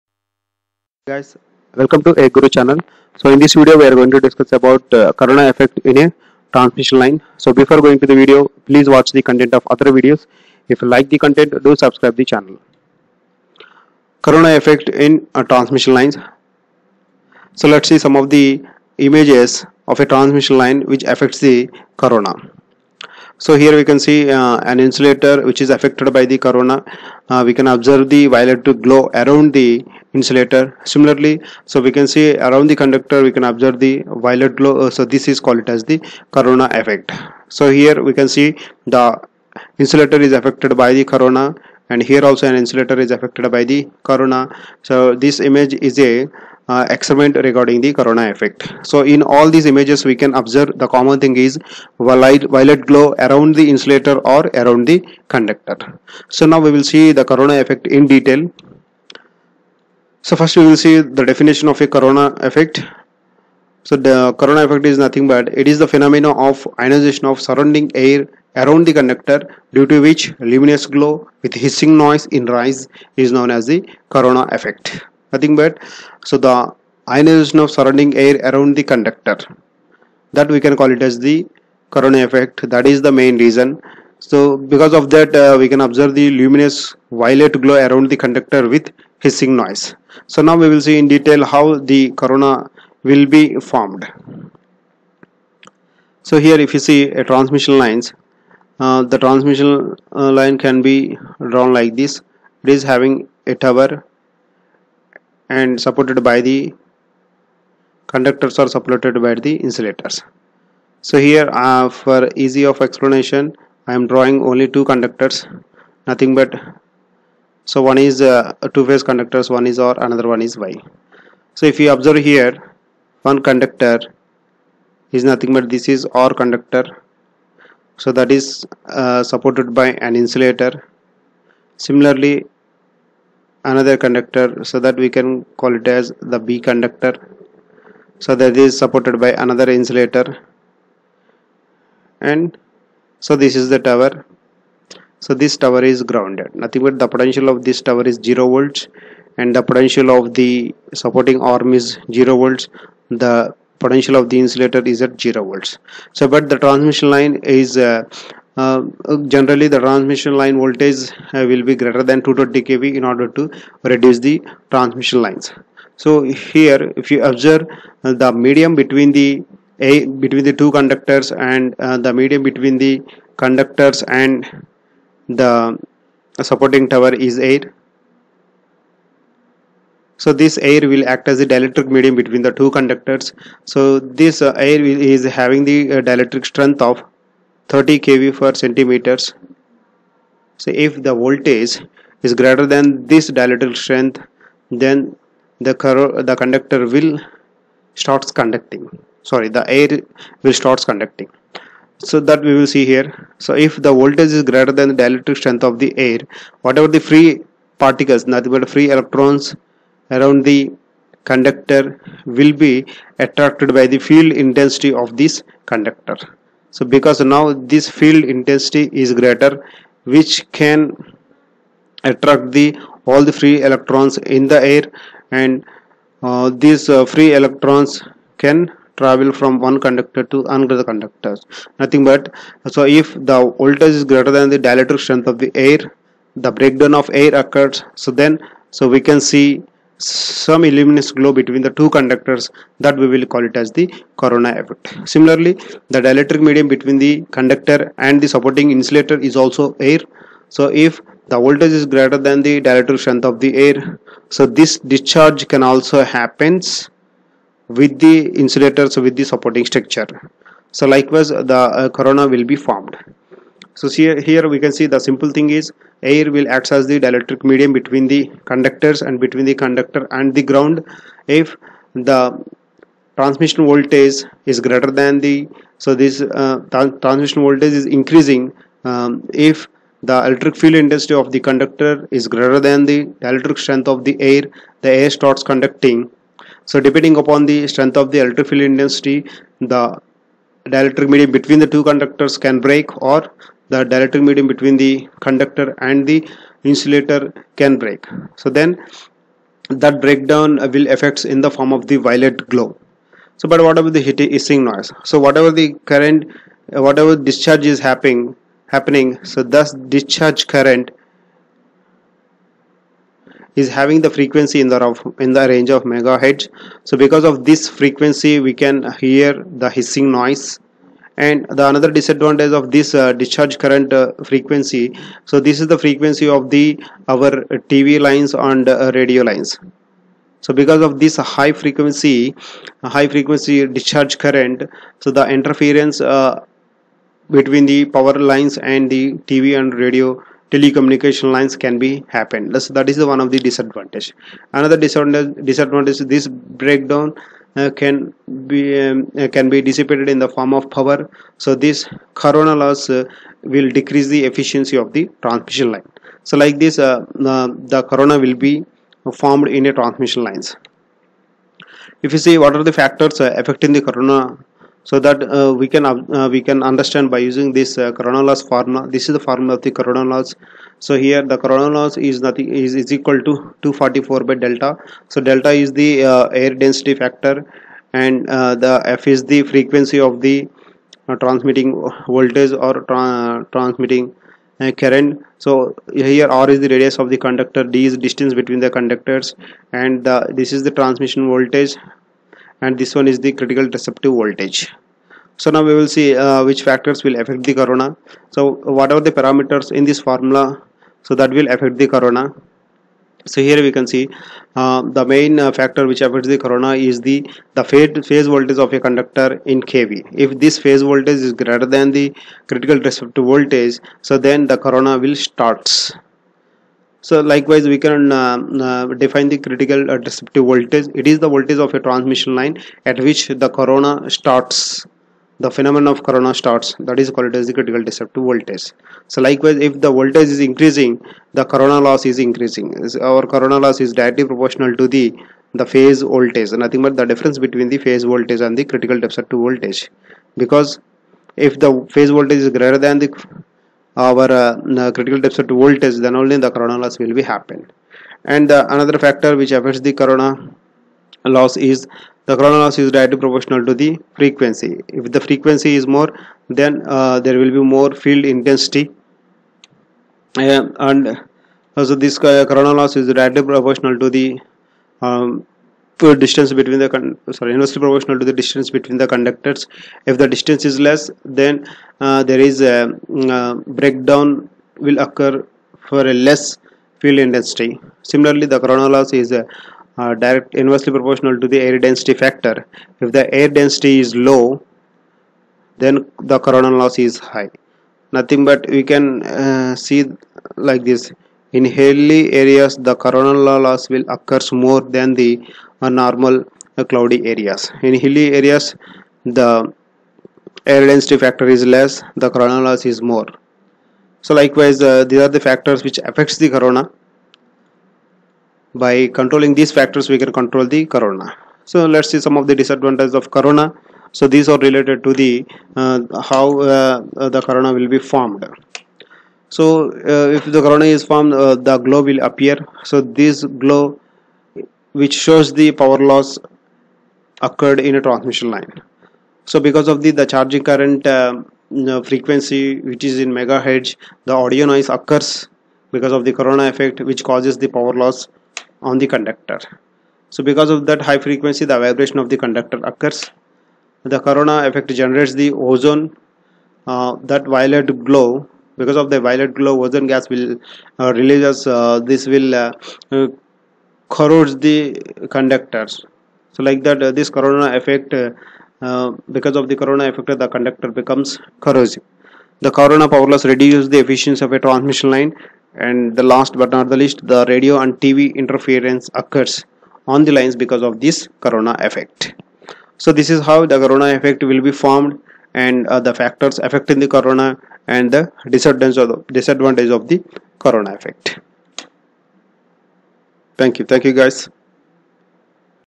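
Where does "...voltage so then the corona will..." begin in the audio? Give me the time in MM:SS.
06:53.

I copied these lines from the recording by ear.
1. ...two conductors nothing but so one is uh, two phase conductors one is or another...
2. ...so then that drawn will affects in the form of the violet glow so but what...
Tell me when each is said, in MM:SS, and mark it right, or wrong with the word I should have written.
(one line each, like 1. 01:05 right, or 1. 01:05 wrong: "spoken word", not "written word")
1. 01:54 right
2. 04:58 wrong: "breakdown", not "drawn".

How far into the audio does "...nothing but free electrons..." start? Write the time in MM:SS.
03:28.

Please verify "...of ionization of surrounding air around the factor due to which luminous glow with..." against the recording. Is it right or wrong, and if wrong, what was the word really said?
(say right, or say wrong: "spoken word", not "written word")
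wrong: "conductor", not "factor".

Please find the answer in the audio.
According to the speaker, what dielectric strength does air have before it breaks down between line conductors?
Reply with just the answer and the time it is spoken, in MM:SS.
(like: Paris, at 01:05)
30 kV per centimeter, at 03:07.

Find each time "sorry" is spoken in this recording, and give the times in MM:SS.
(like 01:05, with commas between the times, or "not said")
03:19, 07:47.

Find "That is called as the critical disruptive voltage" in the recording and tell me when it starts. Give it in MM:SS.
07:06.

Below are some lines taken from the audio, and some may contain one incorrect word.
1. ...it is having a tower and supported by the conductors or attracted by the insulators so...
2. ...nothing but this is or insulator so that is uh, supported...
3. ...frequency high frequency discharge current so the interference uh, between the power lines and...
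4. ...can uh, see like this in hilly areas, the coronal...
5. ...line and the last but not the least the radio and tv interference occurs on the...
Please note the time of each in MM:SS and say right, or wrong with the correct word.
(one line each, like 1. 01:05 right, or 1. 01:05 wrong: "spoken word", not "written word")
1. 01:42 wrong: "supported", not "attracted"
2. 02:05 wrong: "conductor", not "insulator"
3. 05:31 right
4. 08:08 right
5. 09:25 right.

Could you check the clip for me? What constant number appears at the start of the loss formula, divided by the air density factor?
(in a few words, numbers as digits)
244.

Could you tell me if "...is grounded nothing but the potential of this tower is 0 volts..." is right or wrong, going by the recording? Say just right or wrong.
right.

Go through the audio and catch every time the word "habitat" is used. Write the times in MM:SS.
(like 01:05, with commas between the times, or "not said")
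not said.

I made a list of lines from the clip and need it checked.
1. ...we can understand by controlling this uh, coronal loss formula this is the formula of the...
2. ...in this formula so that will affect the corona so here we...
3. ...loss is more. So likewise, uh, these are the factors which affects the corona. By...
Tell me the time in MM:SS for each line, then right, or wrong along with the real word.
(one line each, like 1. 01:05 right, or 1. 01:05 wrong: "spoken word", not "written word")
1. 06:06 wrong: "using", not "controlling"
2. 06:39 right
3. 08:22 right.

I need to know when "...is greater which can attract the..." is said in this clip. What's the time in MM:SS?
03:38.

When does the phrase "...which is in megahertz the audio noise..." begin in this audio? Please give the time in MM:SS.
08:52.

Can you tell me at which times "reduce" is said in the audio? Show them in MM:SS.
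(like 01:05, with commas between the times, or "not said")
02:43, 09:23.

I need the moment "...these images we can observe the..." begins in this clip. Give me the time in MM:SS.
00:49.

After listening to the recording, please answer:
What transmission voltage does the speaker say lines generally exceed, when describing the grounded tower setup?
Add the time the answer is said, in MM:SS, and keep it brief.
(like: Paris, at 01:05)
220 kV, at 02:42.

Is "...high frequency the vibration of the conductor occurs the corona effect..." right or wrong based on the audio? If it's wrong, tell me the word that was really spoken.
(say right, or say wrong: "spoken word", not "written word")
right.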